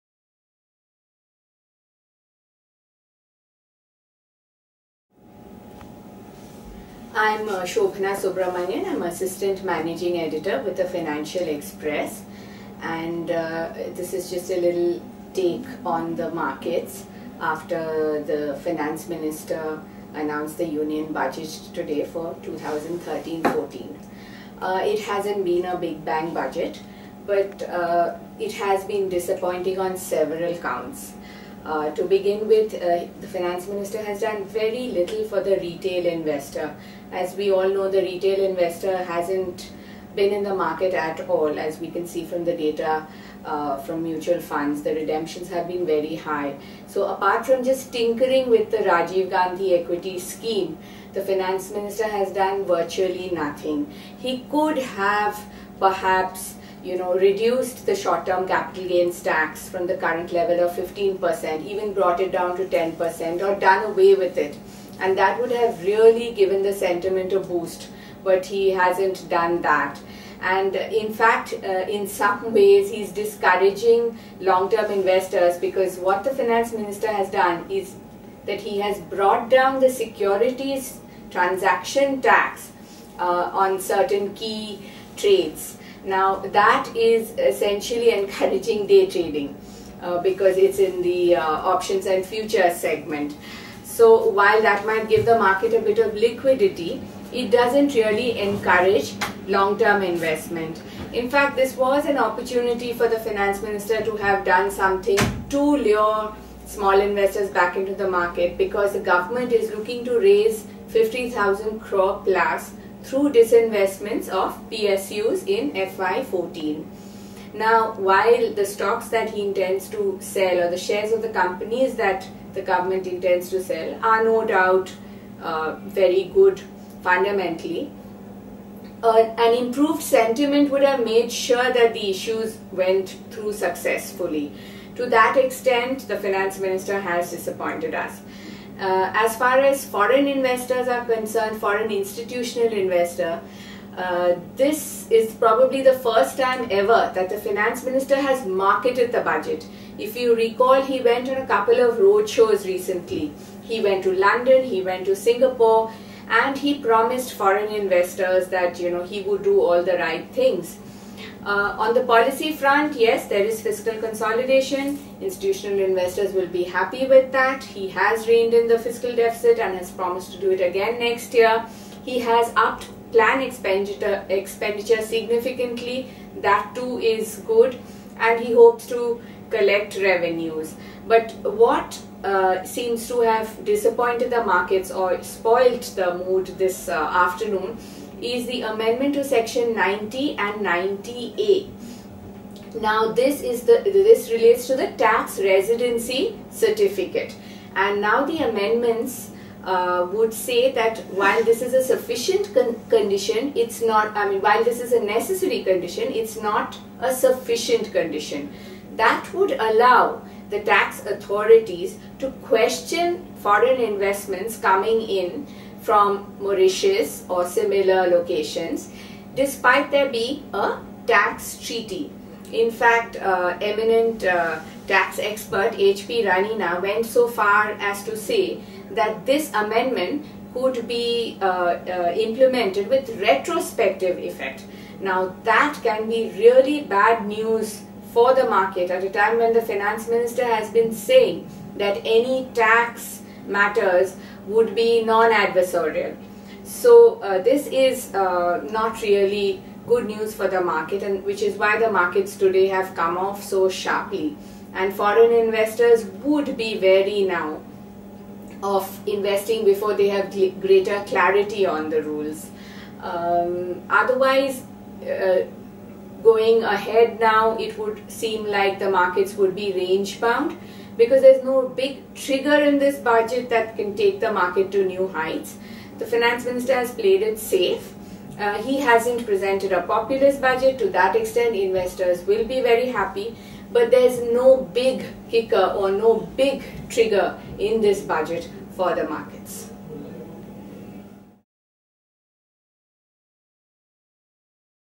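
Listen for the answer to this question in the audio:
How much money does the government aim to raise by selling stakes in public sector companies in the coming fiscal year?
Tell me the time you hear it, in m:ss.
1:50.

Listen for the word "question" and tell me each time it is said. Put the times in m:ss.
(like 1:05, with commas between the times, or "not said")
3:32.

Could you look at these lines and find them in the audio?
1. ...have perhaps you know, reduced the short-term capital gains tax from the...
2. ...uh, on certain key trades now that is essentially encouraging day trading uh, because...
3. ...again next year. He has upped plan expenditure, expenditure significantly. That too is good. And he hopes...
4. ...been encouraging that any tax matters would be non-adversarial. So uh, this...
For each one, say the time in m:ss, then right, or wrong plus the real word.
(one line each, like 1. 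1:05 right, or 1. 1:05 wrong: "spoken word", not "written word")
1. 0:54 right
2. 1:23 right
3. 2:50 right
4. 4:00 wrong: "saying", not "encouraging".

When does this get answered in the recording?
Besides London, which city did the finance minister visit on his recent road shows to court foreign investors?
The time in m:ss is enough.
2:35.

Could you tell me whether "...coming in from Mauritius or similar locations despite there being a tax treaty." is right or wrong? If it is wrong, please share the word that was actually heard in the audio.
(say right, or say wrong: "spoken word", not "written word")
right.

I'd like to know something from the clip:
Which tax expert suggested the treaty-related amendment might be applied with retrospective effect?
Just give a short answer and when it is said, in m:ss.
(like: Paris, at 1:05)
H.P. Ranina, at 3:45.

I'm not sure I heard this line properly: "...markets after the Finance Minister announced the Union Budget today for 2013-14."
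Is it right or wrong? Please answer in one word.
right.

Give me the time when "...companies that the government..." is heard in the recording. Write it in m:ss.
2:01.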